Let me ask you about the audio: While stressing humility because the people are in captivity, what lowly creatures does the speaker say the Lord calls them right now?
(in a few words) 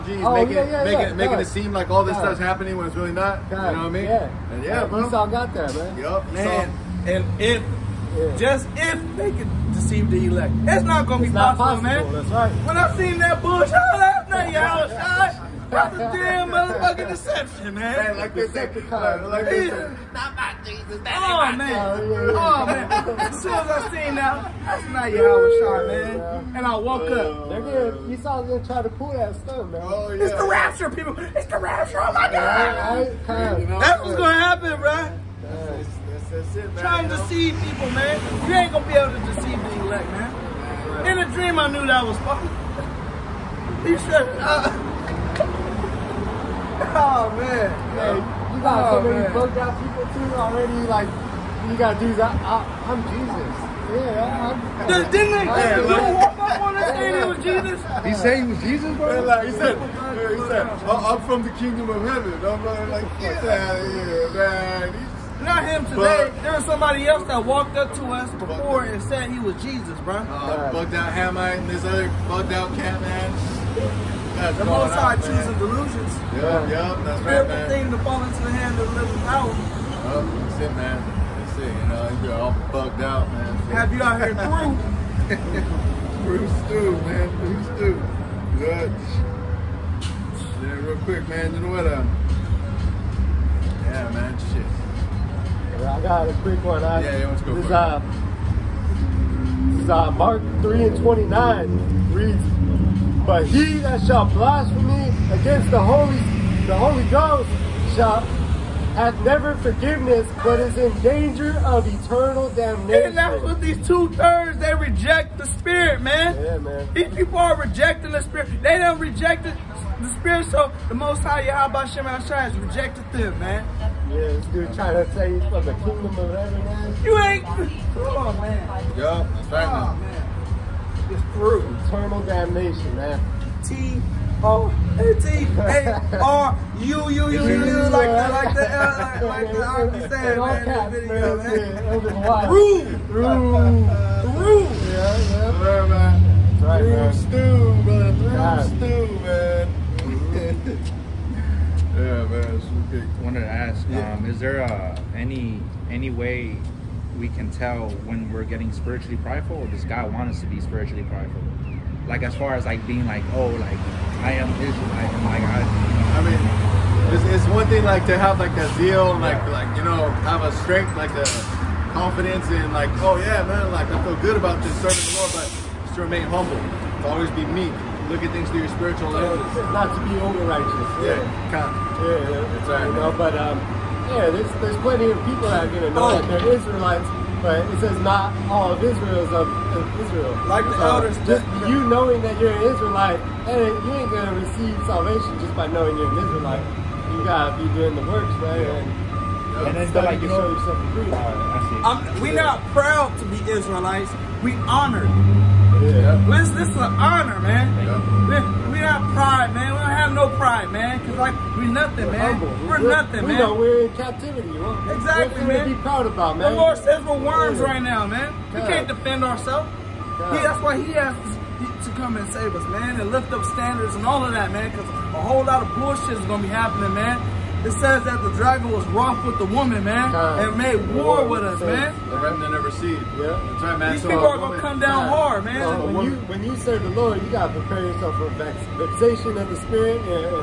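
Worms.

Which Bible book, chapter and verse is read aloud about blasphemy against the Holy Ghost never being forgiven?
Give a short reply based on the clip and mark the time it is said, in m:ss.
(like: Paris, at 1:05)
Mark 3:29, at 1:40.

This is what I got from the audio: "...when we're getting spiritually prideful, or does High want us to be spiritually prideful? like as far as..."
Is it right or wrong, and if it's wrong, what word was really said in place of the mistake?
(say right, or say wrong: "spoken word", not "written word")
wrong: "God", not "High".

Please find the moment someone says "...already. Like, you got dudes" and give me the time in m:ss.
0:50.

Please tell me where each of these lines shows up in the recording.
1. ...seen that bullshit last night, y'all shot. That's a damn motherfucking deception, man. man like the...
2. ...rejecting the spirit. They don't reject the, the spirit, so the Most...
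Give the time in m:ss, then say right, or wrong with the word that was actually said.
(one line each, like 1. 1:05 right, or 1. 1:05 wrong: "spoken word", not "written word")
1. 0:12 right
2. 1:57 right.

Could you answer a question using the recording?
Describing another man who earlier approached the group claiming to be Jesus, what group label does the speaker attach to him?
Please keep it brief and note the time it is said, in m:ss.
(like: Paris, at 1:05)
Hamite, at 1:11.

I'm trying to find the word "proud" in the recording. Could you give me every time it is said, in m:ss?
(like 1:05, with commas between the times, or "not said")
3:22, 3:35.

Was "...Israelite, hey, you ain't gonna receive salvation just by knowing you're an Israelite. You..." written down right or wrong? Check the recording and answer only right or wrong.
right.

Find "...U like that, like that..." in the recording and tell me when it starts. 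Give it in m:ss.
2:17.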